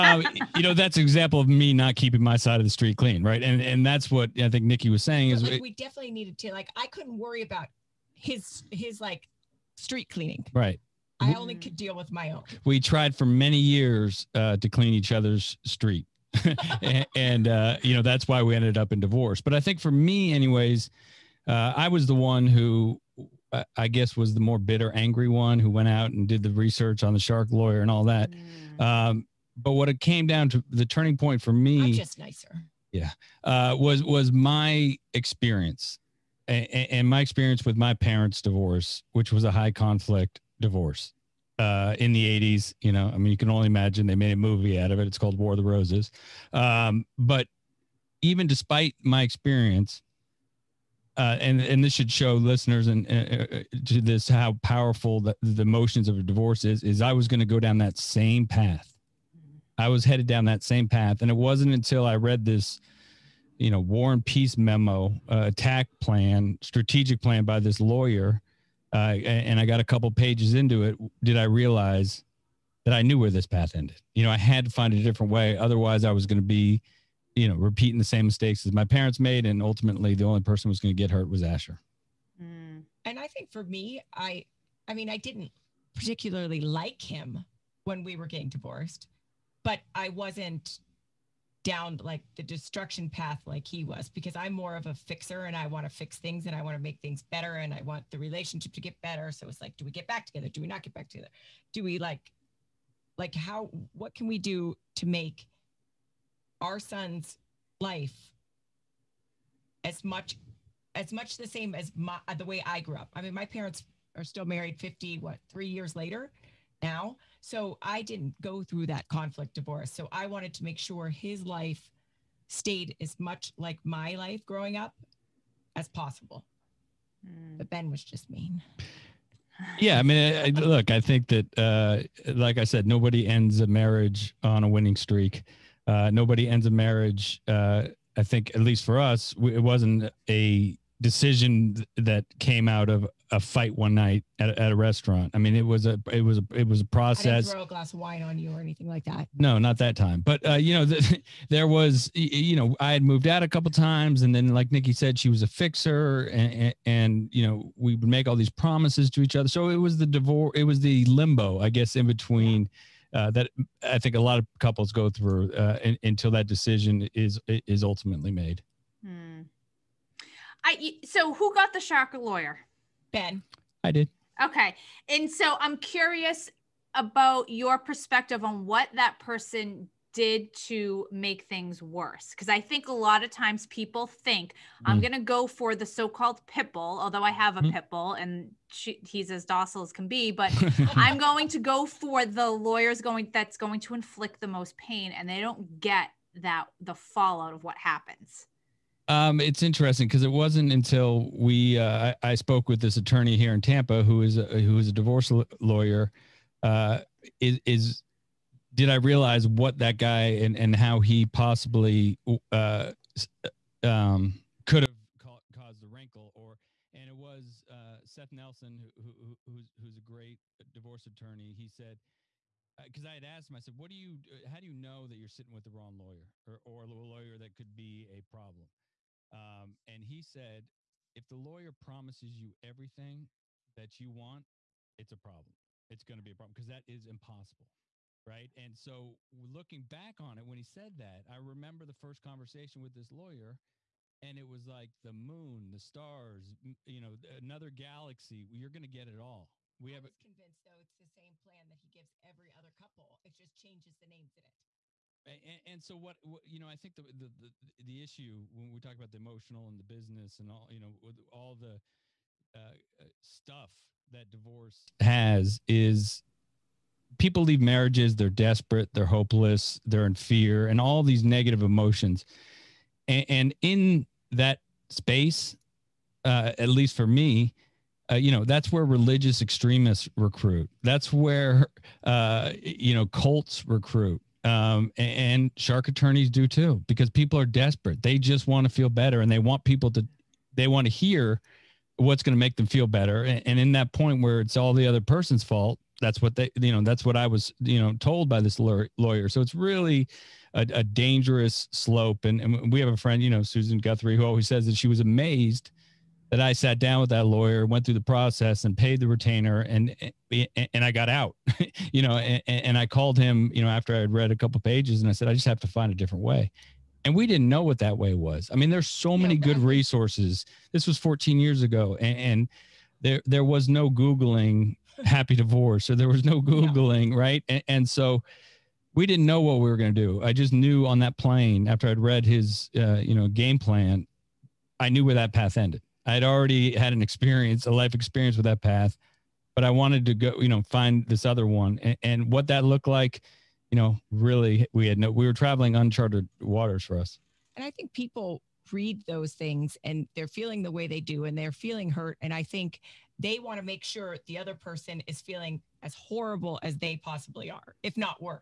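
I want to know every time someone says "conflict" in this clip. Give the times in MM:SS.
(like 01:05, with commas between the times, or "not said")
00:39, 01:59.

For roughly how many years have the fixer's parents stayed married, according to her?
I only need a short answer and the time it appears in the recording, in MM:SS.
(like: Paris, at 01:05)
53, at 01:54.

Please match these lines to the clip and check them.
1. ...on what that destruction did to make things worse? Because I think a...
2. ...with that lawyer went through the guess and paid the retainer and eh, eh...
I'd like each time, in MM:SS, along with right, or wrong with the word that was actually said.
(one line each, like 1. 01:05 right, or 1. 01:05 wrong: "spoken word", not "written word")
1. 02:58 wrong: "person", not "destruction"
2. 05:06 wrong: "process", not "guess".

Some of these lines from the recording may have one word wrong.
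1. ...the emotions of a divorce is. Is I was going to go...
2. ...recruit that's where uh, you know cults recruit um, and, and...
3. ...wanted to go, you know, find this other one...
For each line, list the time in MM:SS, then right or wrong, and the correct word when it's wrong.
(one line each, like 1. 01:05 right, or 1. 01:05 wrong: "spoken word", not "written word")
1. 00:55 right
2. 04:40 right
3. 05:39 right.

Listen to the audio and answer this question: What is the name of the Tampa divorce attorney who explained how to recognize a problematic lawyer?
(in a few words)
Seth Nelson.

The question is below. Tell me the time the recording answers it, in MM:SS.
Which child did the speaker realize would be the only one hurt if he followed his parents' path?
01:21.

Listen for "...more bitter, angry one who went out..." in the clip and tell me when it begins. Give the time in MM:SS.
00:24.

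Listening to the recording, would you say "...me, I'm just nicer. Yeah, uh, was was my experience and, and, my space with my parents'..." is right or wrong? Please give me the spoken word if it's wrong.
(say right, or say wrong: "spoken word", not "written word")
wrong: "experience", not "space".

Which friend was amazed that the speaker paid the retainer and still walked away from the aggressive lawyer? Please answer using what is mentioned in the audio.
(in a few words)
Susan Guthrie.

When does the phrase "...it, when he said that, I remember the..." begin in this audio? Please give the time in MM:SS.
04:00.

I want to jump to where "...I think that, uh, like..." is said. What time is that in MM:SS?
02:10.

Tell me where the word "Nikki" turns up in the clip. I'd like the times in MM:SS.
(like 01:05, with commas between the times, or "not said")
00:04, 02:34.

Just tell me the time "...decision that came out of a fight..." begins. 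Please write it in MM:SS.
02:21.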